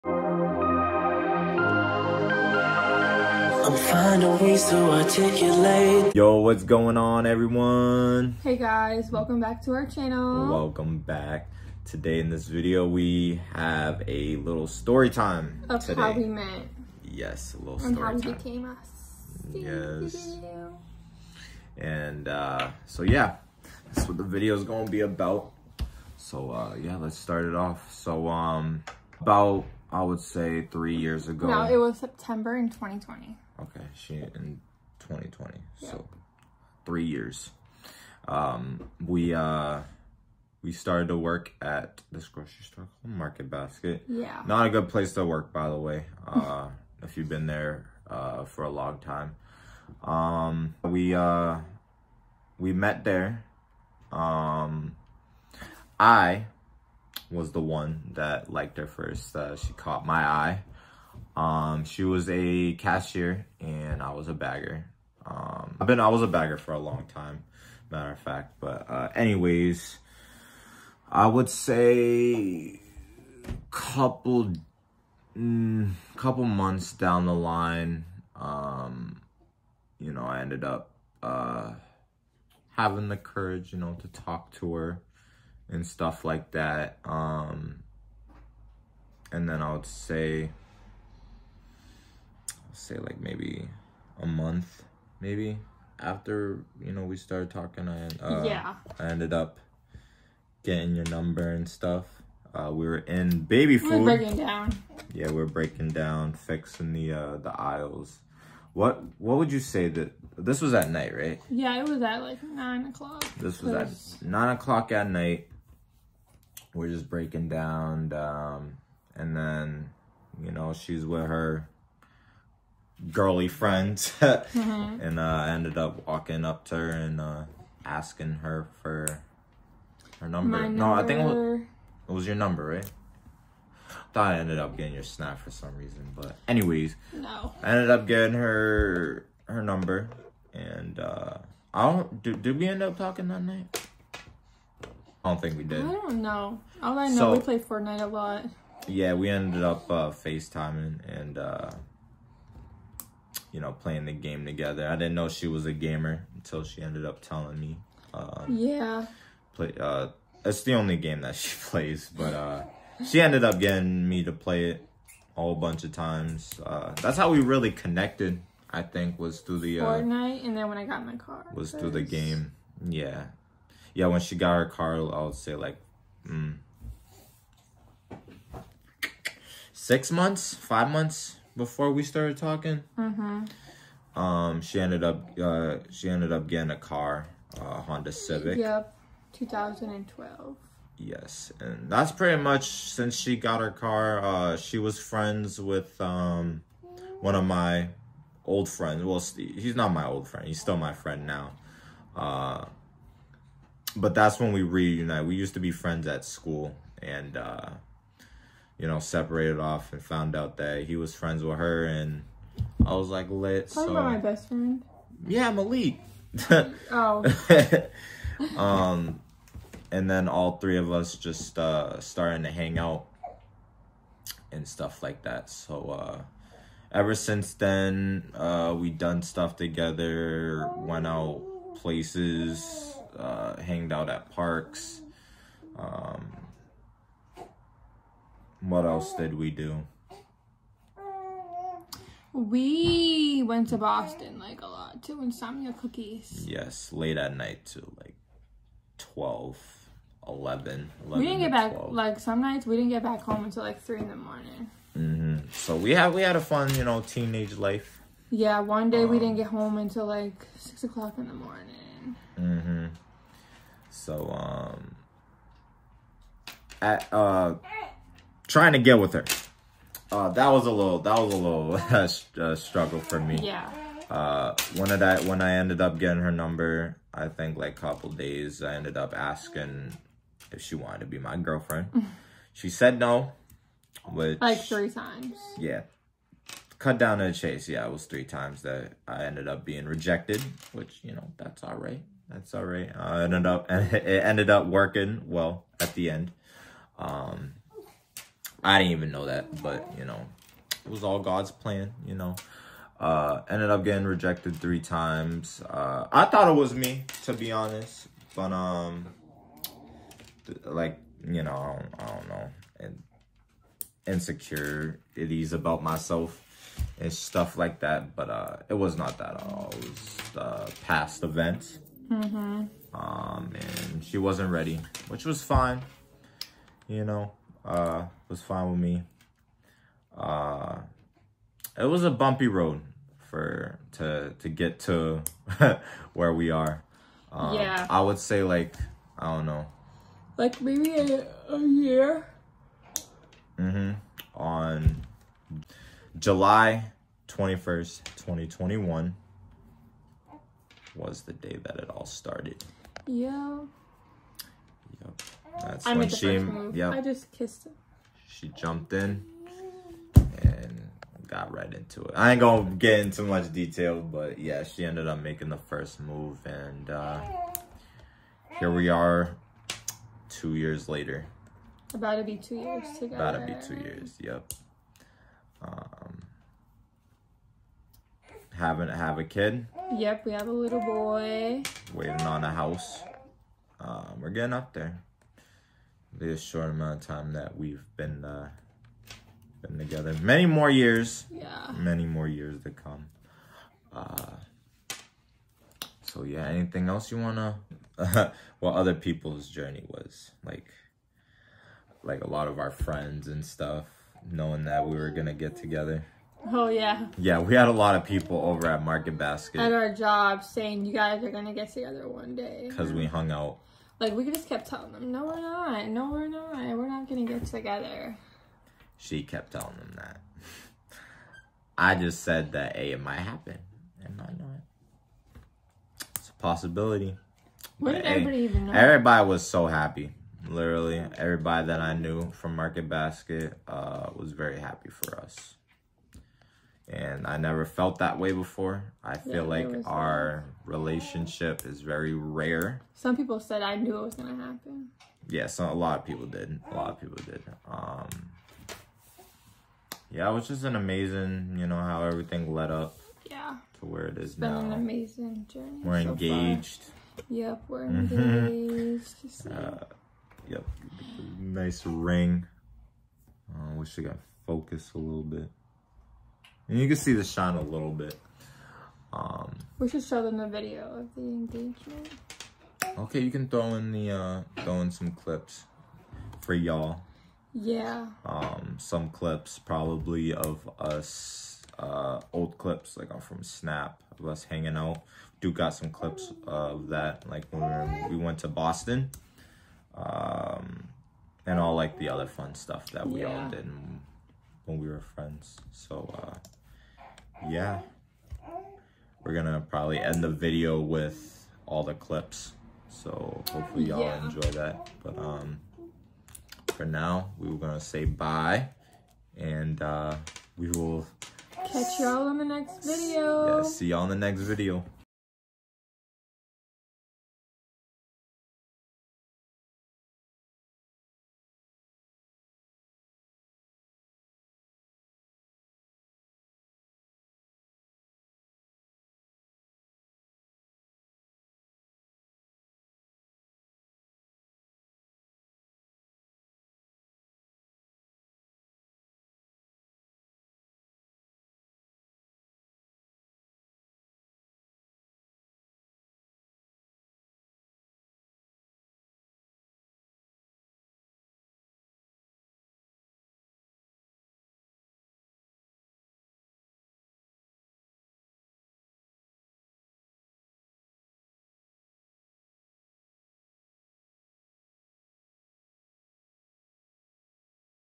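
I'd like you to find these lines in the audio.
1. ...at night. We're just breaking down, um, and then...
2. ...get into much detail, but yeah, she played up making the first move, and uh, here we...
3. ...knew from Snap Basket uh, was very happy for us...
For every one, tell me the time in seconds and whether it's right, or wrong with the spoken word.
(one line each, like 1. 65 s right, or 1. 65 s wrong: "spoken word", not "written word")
1. 114 s right
2. 362 s wrong: "ended", not "played"
3. 431 s wrong: "Market", not "Snap".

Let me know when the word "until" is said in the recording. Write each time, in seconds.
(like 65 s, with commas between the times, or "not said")
156 s, 253 s, 259 s.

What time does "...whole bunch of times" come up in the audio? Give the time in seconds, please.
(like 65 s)
165 s.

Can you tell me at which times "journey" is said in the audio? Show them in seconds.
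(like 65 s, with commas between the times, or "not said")
399 s, 455 s.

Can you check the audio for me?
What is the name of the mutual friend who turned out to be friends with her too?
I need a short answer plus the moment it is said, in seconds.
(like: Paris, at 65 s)
Malik, at 215 s.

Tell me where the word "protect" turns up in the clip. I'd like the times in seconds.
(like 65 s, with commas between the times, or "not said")
not said.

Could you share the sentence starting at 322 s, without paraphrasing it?
hmm Um, and she wasn't ready, which was fine, you know uh, was fine with me.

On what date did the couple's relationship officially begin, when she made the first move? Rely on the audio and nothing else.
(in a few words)
July 21, 2021.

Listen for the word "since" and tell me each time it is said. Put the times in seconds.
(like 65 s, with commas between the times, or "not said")
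192 s, 227 s.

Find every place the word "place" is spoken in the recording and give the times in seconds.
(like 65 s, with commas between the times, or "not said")
44 s, 231 s.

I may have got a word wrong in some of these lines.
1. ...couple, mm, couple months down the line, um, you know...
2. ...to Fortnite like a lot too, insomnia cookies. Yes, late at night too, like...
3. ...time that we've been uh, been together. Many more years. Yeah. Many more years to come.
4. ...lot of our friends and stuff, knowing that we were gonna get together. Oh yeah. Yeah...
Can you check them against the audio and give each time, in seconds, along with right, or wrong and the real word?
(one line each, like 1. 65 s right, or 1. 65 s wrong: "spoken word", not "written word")
1. 73 s right
2. 243 s wrong: "Boston", not "Fortnite"
3. 387 s right
4. 402 s right.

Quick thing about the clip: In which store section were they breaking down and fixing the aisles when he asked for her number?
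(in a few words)
baby food.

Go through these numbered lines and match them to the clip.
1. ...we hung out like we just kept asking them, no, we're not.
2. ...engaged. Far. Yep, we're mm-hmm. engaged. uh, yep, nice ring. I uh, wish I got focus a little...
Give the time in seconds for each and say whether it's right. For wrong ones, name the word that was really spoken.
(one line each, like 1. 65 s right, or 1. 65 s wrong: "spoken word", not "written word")
1. 412 s wrong: "telling", not "asking"
2. 456 s right.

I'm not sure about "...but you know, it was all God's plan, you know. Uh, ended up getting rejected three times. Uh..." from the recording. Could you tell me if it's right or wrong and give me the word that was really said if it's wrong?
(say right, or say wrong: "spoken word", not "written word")
right.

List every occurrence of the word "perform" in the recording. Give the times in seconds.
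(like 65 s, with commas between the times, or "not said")
not said.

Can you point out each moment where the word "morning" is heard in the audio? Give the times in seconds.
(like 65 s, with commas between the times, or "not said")
254 s, 261 s.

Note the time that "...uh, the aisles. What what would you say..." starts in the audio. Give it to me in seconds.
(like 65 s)
107 s.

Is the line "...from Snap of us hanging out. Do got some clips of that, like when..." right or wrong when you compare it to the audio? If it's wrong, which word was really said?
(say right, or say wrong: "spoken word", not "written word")
right.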